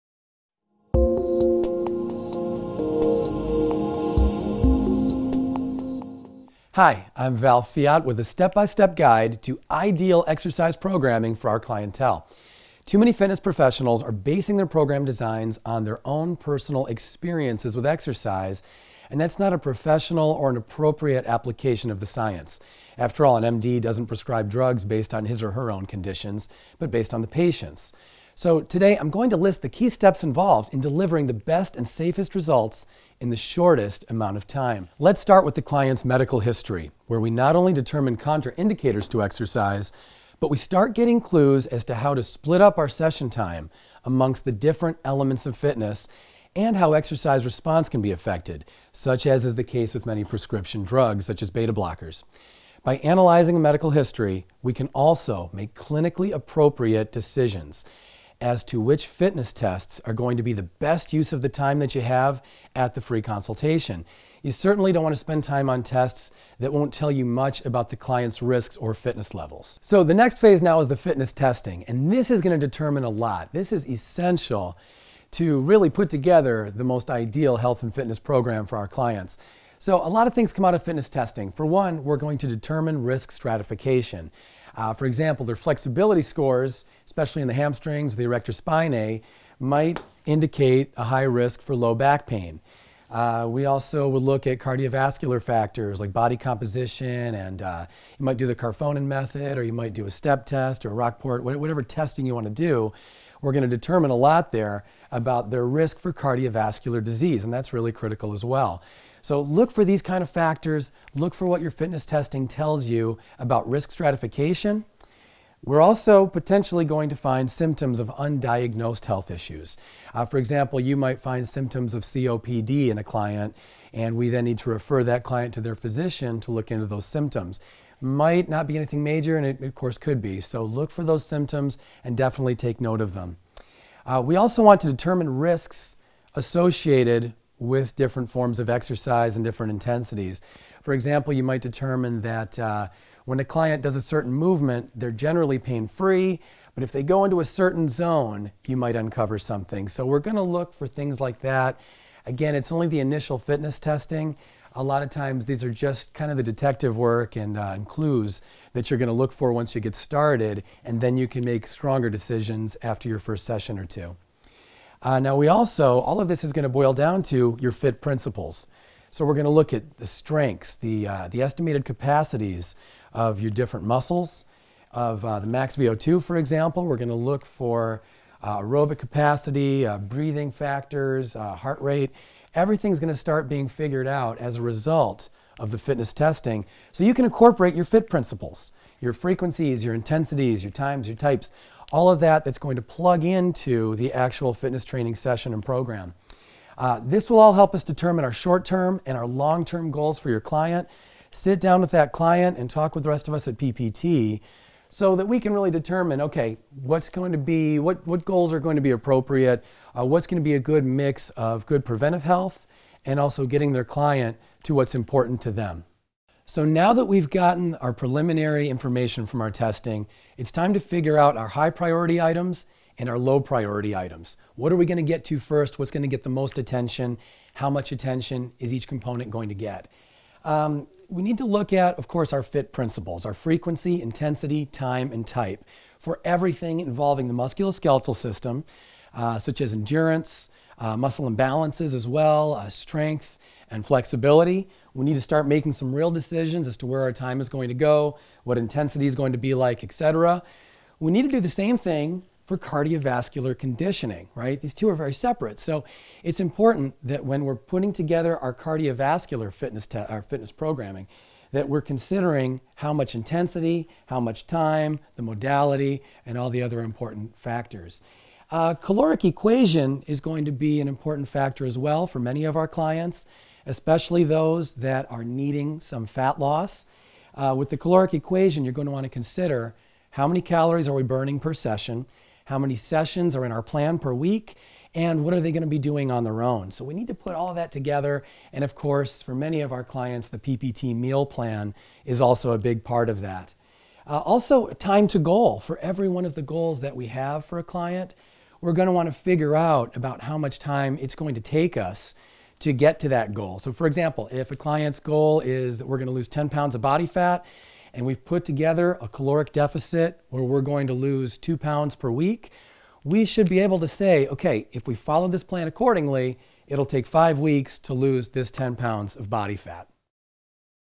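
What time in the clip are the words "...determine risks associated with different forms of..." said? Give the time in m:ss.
2:14.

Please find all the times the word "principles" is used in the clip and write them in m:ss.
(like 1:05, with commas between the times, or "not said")
2:48, 3:08, 3:52.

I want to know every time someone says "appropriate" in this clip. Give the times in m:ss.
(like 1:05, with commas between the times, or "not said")
0:20, 0:56, 3:28.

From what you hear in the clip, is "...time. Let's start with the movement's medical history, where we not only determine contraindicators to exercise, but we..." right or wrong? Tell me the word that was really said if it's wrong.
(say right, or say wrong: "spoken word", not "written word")
wrong: "client", not "movement".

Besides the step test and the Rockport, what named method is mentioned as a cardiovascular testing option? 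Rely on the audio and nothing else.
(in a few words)
Karvonen method.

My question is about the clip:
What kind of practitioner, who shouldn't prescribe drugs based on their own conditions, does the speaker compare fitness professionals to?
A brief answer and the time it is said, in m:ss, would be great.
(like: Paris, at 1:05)
MD, at 0:23.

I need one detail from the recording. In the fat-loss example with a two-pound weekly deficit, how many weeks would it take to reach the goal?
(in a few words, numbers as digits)
5.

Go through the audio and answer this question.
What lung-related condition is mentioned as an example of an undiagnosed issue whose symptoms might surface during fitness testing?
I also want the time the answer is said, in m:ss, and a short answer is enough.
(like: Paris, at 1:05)
COPD, at 2:02.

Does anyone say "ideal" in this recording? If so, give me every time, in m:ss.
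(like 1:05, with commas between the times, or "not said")
0:09, 1:17.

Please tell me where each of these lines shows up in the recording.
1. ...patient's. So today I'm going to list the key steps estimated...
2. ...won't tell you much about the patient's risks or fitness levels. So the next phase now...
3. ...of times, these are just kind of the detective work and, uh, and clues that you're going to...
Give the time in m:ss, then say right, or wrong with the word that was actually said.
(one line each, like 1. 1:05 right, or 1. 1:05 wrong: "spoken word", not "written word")
1. 0:27 wrong: "involved", not "estimated"
2. 1:06 wrong: "client", not "patient"
3. 2:35 right.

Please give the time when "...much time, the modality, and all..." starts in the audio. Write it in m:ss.
4:24.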